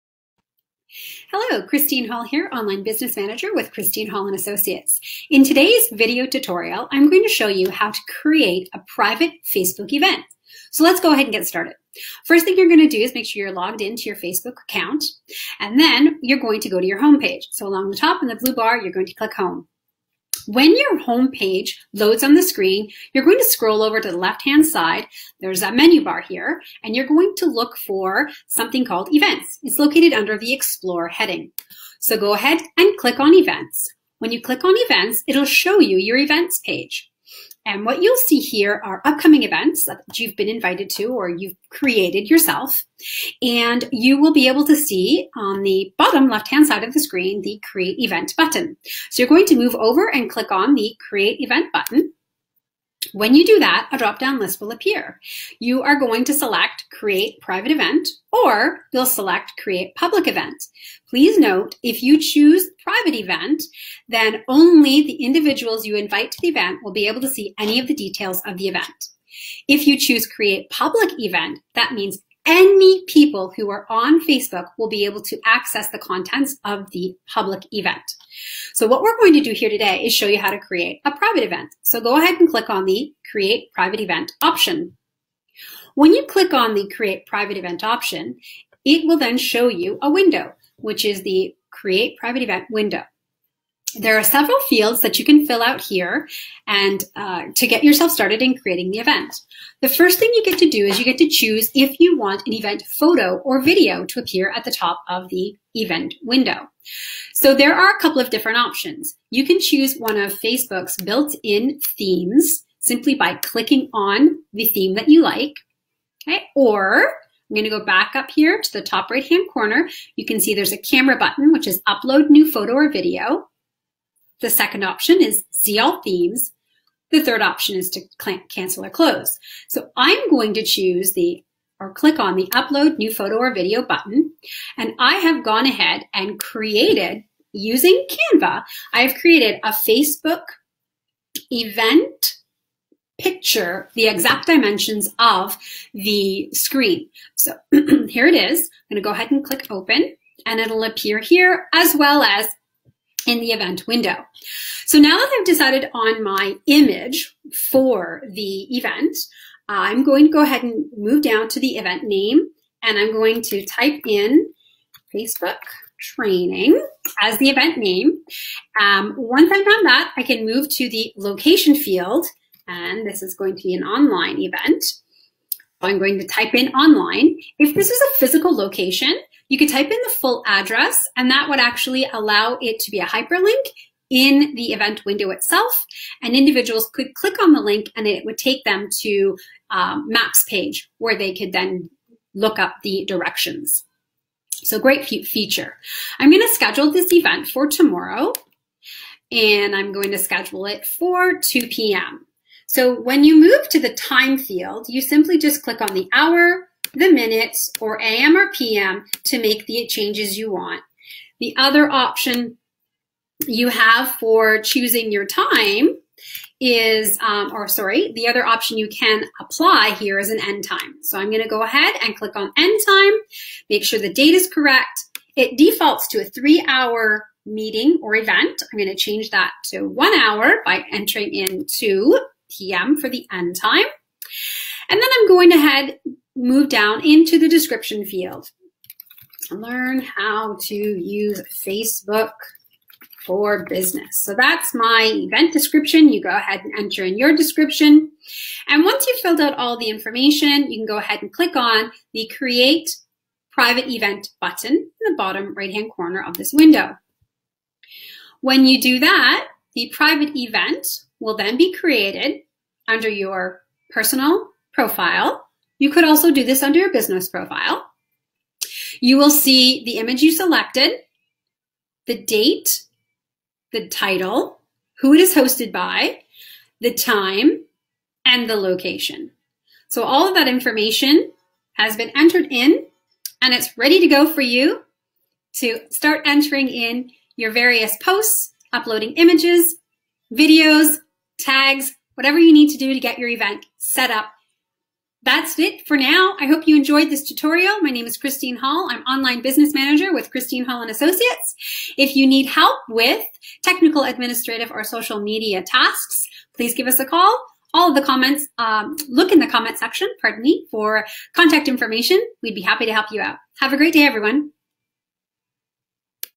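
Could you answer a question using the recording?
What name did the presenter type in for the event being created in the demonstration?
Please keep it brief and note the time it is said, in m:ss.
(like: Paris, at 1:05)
Facebook training, at 2:45.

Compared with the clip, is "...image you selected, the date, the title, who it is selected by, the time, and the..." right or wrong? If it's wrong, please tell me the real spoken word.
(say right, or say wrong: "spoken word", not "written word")
wrong: "hosted", not "selected".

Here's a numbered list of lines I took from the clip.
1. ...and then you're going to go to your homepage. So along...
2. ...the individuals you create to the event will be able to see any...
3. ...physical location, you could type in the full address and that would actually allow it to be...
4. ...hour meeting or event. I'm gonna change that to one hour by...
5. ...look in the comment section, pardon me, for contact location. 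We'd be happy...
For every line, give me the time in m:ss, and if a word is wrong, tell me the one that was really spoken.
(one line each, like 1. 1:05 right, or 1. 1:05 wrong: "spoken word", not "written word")
1. 0:15 right
2. 1:05 wrong: "invite", not "create"
3. 2:58 right
4. 3:46 right
5. 5:09 wrong: "information", not "location".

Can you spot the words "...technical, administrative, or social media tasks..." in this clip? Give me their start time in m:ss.
5:03.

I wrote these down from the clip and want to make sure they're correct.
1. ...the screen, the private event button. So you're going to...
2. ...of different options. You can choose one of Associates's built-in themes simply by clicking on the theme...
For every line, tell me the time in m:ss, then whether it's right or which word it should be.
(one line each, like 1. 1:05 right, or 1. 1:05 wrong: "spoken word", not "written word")
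1. 0:46 wrong: "create", not "private"
2. 1:48 wrong: "Facebook", not "Associates".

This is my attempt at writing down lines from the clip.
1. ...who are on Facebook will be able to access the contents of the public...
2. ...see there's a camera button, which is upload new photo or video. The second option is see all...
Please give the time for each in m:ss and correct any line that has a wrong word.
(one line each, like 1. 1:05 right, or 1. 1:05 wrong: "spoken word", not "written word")
1. 1:13 right
2. 2:00 right.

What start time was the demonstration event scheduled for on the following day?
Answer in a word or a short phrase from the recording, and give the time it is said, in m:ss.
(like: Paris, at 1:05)
2 p.m., at 3:21.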